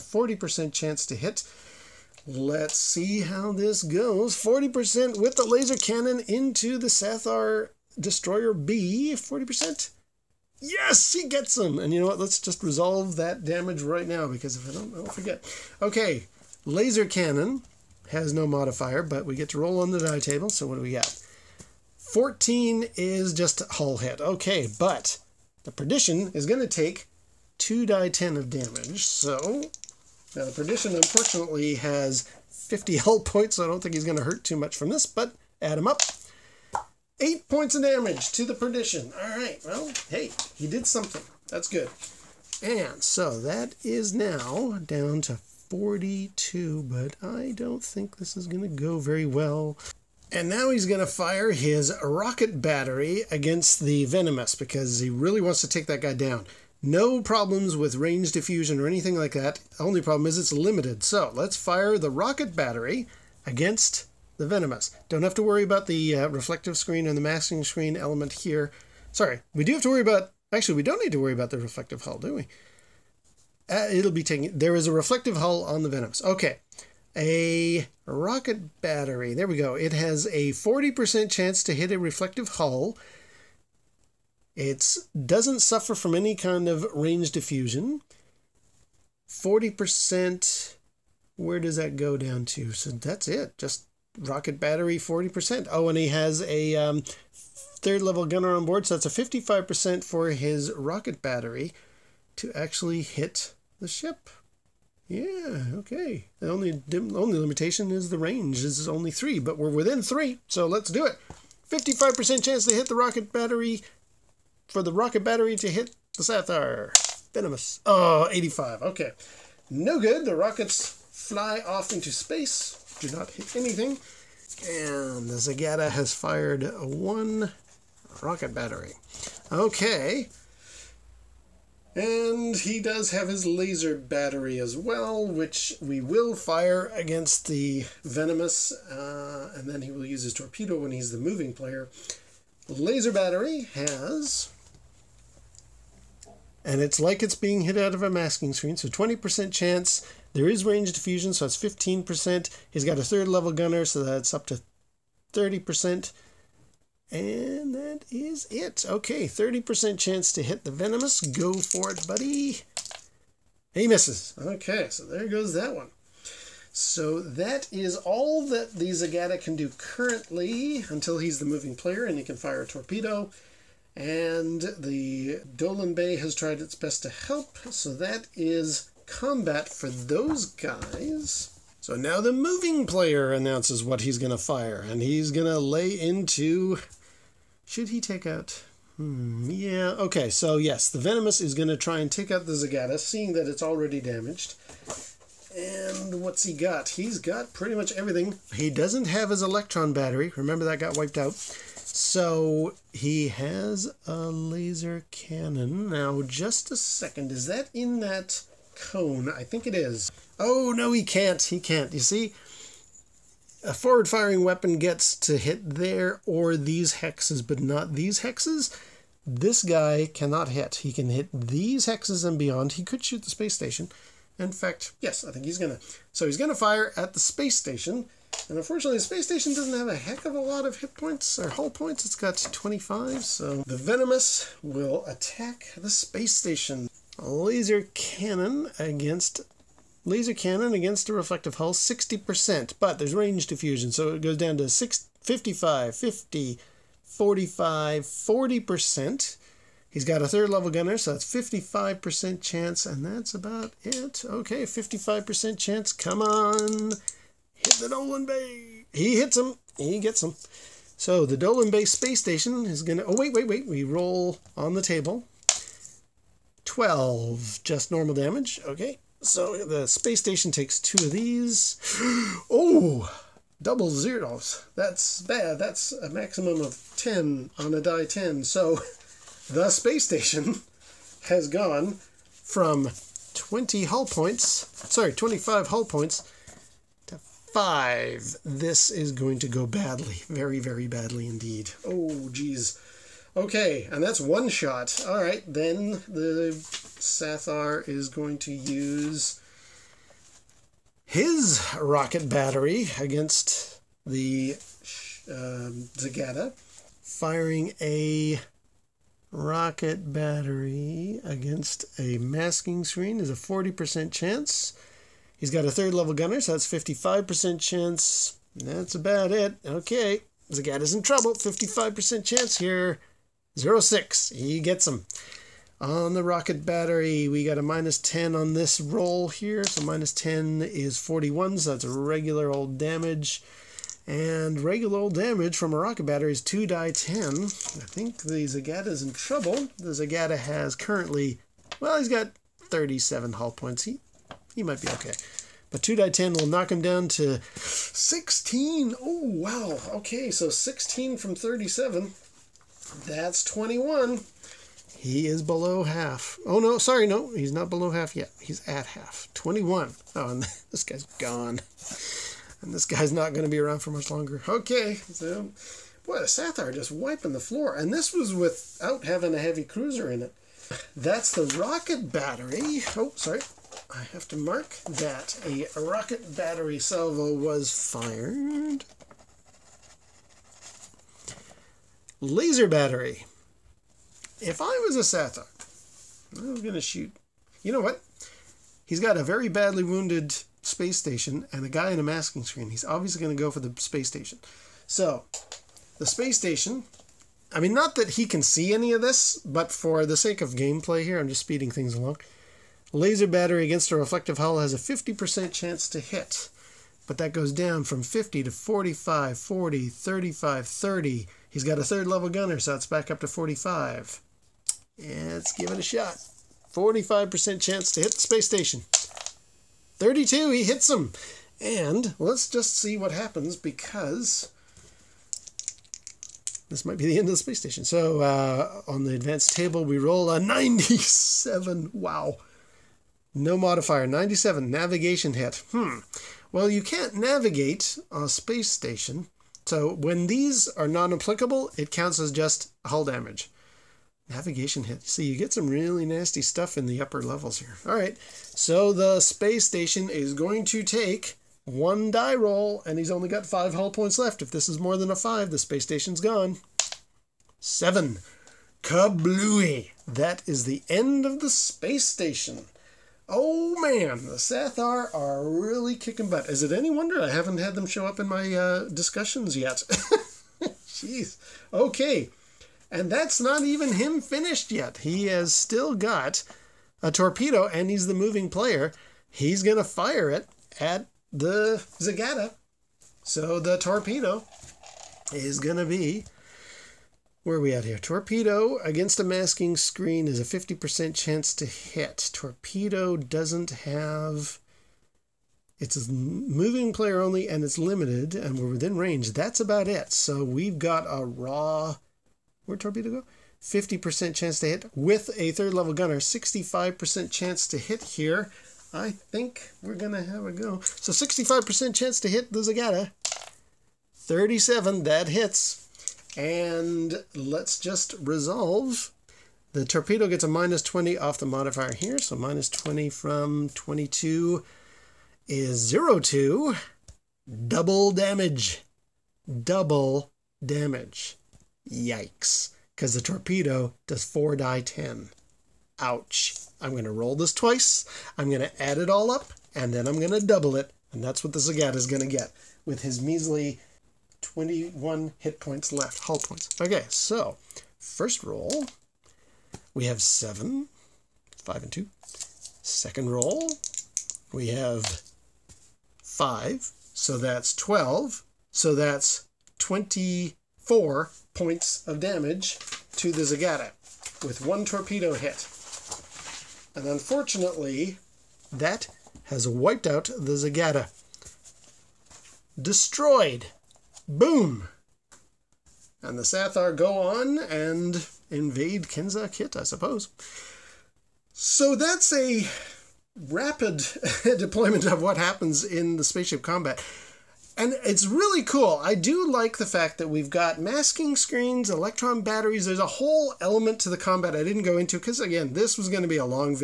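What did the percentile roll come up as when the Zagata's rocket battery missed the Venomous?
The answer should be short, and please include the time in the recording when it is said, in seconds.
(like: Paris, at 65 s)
85, at 118 s.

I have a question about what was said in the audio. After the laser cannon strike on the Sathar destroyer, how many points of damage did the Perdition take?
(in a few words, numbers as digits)
8.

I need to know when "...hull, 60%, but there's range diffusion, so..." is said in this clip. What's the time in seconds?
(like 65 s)
241 s.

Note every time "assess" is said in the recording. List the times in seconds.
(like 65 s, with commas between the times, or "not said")
not said.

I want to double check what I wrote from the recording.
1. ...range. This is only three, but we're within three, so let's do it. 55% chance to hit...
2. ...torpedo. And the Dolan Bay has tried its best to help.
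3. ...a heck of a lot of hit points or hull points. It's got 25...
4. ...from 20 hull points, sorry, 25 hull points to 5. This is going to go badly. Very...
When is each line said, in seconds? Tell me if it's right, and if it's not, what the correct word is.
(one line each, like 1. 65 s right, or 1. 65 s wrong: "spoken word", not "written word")
1. 108 s right
2. 172 s right
3. 229 s right
4. 282 s right.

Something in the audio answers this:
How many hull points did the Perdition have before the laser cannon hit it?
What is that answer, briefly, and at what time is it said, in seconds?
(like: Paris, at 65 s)
50, at 32 s.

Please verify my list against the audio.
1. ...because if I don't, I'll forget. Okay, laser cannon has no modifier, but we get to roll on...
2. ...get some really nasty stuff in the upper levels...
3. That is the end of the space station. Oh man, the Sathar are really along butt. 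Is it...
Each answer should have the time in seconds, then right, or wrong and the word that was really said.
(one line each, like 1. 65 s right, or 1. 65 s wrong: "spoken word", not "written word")
1. 14 s right
2. 445 s right
3. 460 s wrong: "kicking", not "along".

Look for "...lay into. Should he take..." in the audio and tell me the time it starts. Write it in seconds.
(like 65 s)
185 s.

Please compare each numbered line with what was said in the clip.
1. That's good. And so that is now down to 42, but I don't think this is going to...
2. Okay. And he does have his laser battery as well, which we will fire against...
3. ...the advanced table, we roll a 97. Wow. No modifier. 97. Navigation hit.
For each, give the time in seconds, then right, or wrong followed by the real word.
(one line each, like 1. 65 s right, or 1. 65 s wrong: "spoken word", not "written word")
1. 41 s right
2. 129 s right
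3. 429 s right.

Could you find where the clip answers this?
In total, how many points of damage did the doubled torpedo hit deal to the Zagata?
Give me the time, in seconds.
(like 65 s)
559 s.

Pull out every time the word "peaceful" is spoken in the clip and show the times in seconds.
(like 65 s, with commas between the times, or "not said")
not said.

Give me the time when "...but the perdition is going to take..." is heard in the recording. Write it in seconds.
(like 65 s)
24 s.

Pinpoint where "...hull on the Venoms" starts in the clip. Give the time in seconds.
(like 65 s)
75 s.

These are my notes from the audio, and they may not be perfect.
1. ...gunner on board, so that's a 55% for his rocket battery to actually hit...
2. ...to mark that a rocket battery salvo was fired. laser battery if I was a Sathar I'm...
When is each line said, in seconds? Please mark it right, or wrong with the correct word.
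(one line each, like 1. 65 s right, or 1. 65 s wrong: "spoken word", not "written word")
1. 98 s right
2. 374 s right.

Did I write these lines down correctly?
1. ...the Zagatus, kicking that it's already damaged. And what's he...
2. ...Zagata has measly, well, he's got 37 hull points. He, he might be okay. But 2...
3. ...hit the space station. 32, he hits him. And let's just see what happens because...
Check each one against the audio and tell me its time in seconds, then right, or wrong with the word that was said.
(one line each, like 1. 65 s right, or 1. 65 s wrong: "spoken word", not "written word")
1. 192 s wrong: "seeing", not "kicking"
2. 339 s wrong: "currently", not "measly"
3. 418 s right.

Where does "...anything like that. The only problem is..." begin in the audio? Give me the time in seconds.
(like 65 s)
58 s.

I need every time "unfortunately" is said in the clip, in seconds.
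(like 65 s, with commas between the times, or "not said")
30 s, 228 s, 567 s.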